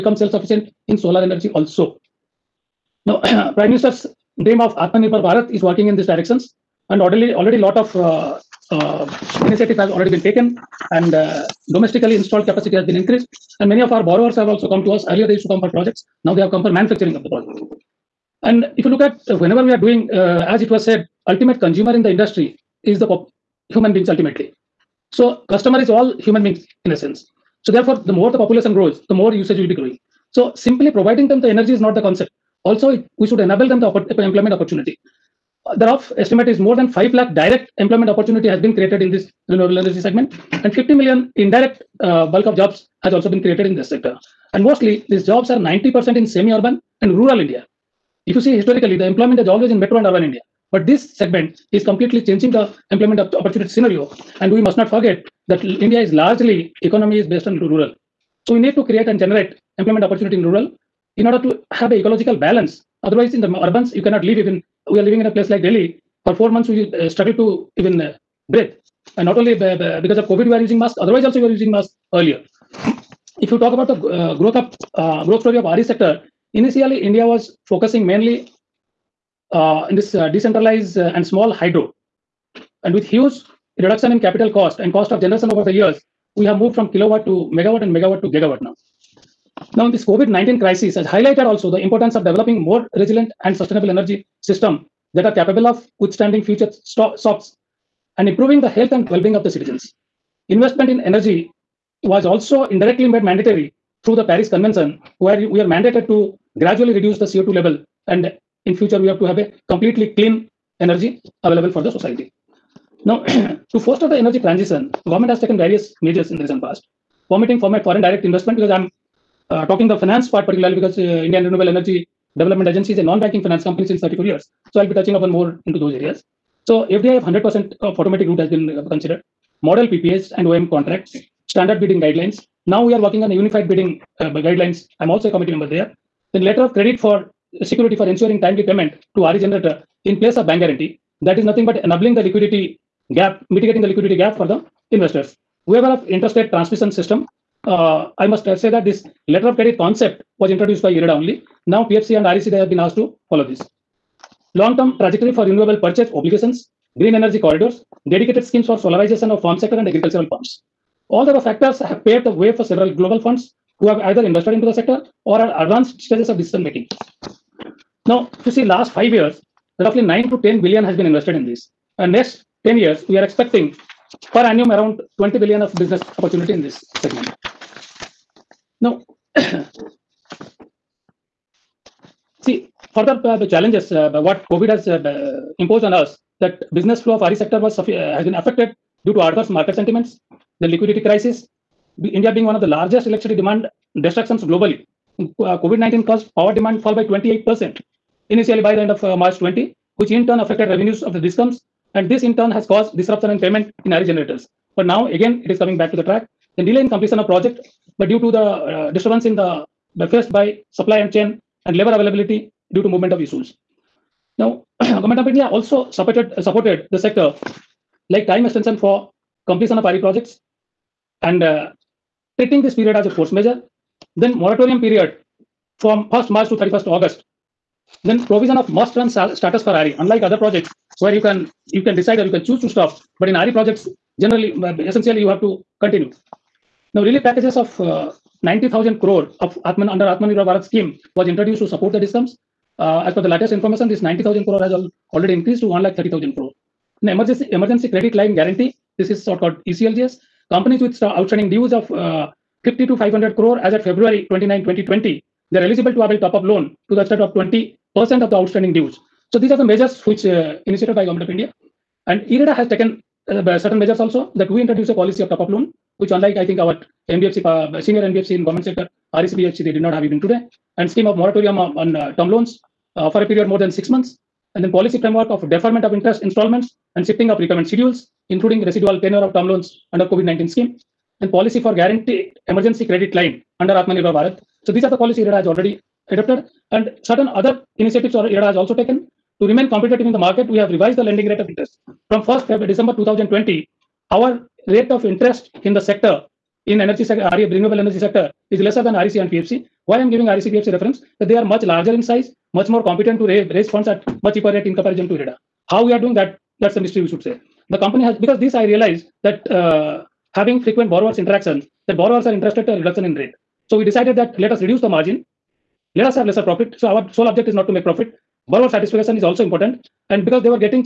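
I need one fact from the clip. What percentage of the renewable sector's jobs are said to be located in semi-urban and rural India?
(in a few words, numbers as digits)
90%.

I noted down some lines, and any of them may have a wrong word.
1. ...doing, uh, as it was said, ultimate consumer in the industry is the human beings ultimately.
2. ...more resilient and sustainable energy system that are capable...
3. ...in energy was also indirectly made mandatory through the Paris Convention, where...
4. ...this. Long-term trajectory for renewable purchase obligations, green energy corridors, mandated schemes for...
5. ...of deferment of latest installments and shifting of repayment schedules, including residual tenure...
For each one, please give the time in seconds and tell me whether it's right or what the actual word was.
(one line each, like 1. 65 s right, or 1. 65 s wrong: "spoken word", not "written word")
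1. 19 s right
2. 92 s right
3. 100 s right
4. 153 s wrong: "dedicated", not "mandated"
5. 275 s wrong: "interest", not "latest".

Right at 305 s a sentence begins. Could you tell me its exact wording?
How we are doing that, that's a mystery, we should say.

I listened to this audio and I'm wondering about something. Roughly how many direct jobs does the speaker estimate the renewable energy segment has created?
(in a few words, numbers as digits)
More than 5 lakh.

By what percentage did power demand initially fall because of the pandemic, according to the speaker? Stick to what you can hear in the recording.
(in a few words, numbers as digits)
28%.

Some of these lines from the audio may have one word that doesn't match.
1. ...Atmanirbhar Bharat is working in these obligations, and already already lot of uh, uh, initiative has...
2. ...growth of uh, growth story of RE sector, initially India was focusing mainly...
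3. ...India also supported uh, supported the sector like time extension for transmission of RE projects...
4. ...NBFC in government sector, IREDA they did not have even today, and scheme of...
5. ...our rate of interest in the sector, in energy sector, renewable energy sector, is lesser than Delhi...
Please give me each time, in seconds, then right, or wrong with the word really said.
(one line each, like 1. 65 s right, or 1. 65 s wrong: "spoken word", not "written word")
1. 4 s wrong: "directions", not "obligations"
2. 74 s right
3. 215 s wrong: "completion", not "transmission"
4. 268 s wrong: "RSBFC", not "IREDA"
5. 294 s wrong: "REC", not "Delhi".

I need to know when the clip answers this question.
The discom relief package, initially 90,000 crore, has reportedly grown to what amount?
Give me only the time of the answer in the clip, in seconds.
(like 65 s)
245 s.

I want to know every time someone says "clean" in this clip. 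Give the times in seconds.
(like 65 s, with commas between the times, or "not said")
110 s.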